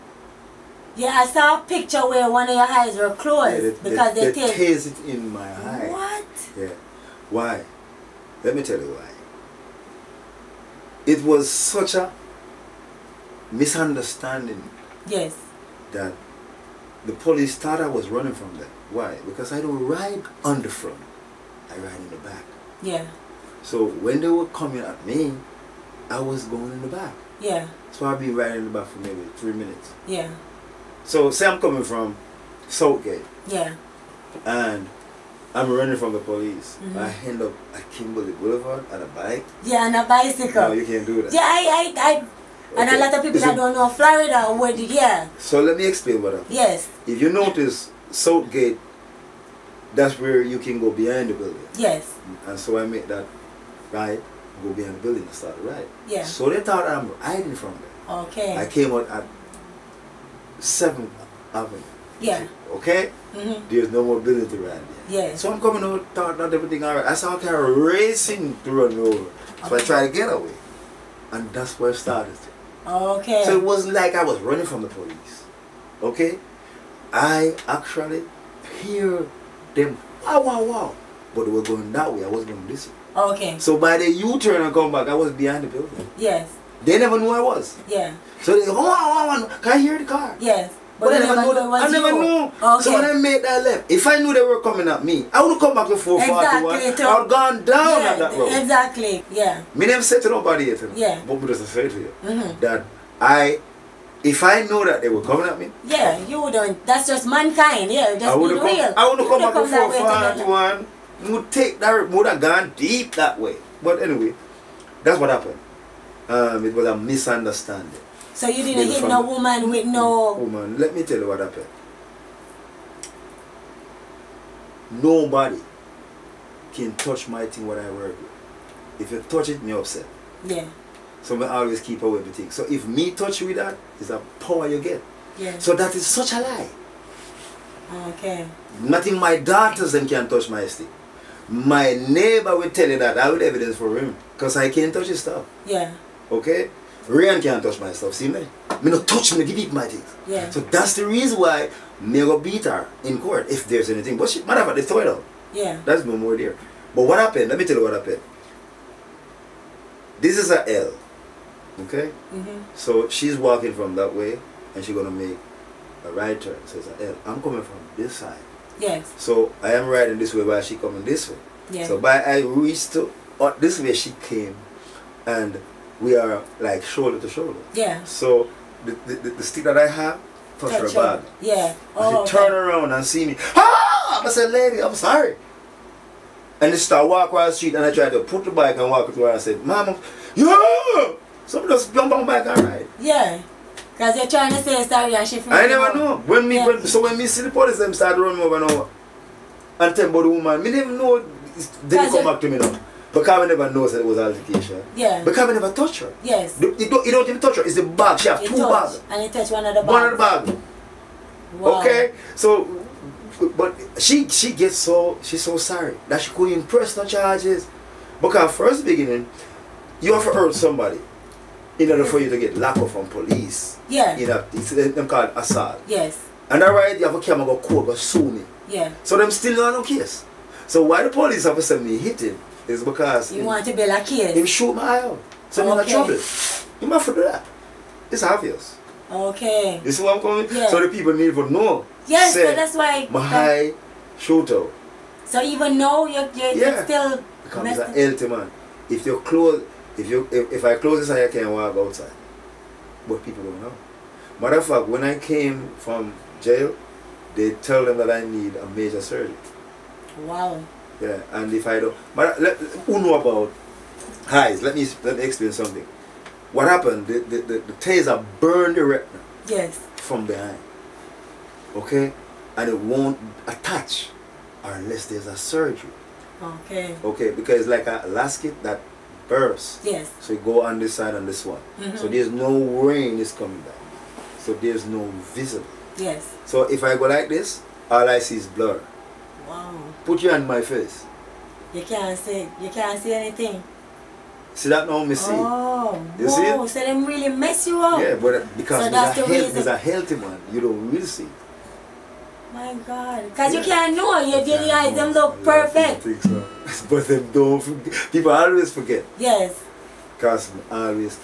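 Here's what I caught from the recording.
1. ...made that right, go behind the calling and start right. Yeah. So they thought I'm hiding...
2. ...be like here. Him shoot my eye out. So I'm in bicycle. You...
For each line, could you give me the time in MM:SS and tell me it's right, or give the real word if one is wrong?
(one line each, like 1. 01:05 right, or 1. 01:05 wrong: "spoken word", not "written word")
1. 00:52 wrong: "building", not "calling"
2. 03:53 wrong: "trouble", not "bicycle".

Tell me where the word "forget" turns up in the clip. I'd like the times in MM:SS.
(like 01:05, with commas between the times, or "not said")
05:08.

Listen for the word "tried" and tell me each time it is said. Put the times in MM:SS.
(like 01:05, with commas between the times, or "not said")
01:09, 03:07.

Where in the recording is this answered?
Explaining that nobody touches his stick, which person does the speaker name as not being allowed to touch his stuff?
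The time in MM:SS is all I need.
02:27.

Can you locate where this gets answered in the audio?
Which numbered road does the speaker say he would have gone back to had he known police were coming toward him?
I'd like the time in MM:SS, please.
01:35.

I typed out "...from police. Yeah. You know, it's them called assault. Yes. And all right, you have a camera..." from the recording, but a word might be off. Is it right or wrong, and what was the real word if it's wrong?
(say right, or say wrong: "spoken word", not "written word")
right.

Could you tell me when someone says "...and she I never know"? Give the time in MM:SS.
03:15.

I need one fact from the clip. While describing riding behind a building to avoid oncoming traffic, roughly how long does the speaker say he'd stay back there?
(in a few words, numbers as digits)
3 minutes.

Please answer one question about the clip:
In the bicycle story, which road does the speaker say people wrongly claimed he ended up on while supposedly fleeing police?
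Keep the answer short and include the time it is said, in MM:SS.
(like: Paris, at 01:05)
Kimberly Boulevard, at 00:37.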